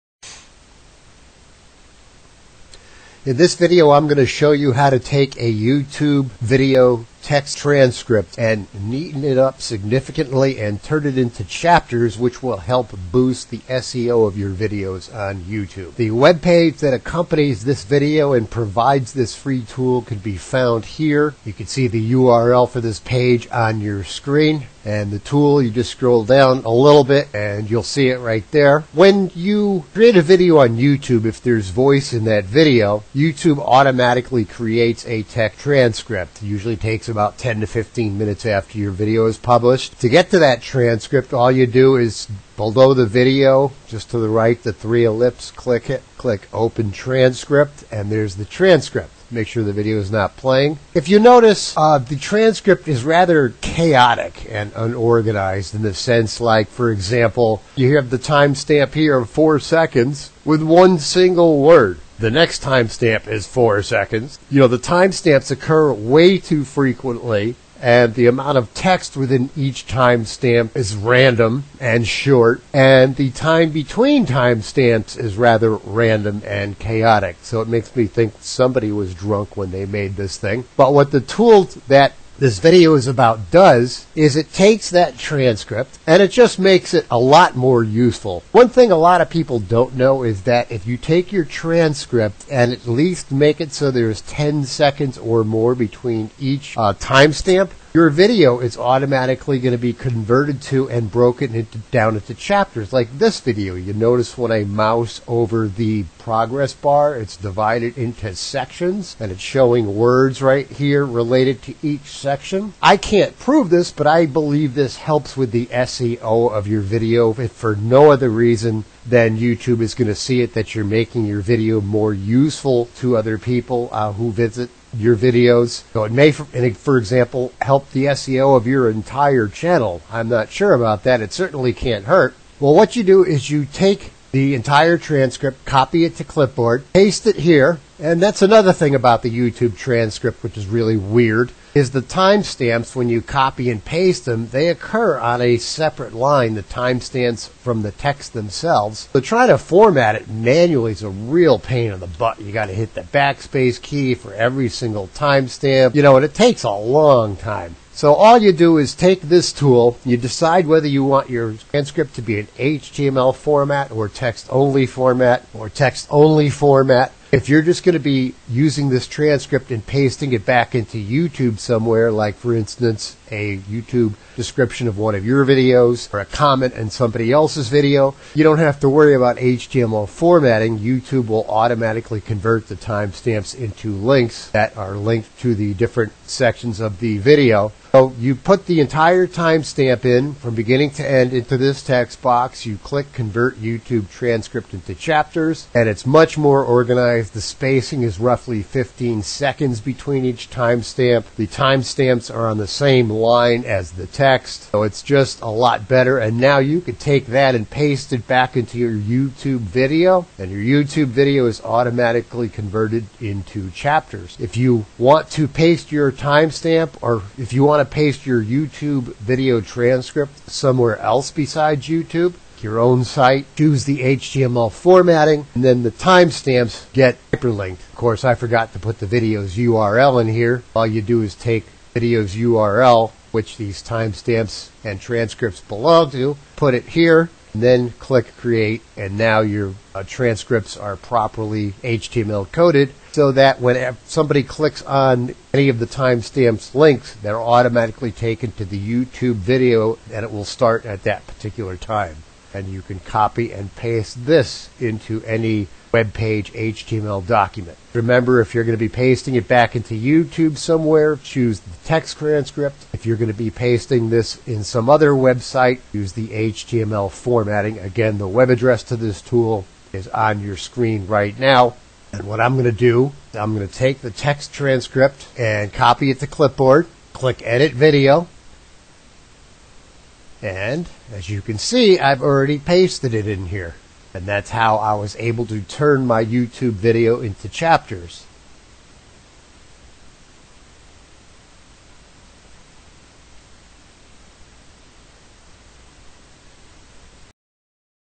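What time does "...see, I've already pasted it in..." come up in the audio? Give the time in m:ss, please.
4:41.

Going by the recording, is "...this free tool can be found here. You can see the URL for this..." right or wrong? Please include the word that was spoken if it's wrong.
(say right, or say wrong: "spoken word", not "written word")
right.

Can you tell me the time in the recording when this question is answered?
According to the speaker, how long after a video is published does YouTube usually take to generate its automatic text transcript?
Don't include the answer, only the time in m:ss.
0:37.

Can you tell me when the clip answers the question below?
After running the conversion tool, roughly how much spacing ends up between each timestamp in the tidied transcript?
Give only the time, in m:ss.
3:18.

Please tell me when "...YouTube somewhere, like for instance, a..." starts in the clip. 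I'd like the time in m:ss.
2:50.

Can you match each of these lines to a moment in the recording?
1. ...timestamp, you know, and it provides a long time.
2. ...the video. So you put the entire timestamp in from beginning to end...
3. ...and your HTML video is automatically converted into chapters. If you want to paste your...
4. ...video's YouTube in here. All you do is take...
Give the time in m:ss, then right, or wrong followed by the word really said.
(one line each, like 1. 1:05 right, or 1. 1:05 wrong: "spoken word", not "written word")
1. 2:35 wrong: "takes", not "provides"
2. 3:06 right
3. 3:30 wrong: "YouTube", not "HTML"
4. 3:49 wrong: "URL", not "YouTube".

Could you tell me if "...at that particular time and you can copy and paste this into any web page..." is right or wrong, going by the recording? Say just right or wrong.
right.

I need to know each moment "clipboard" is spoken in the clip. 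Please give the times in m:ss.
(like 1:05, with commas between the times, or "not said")
2:16, 4:36.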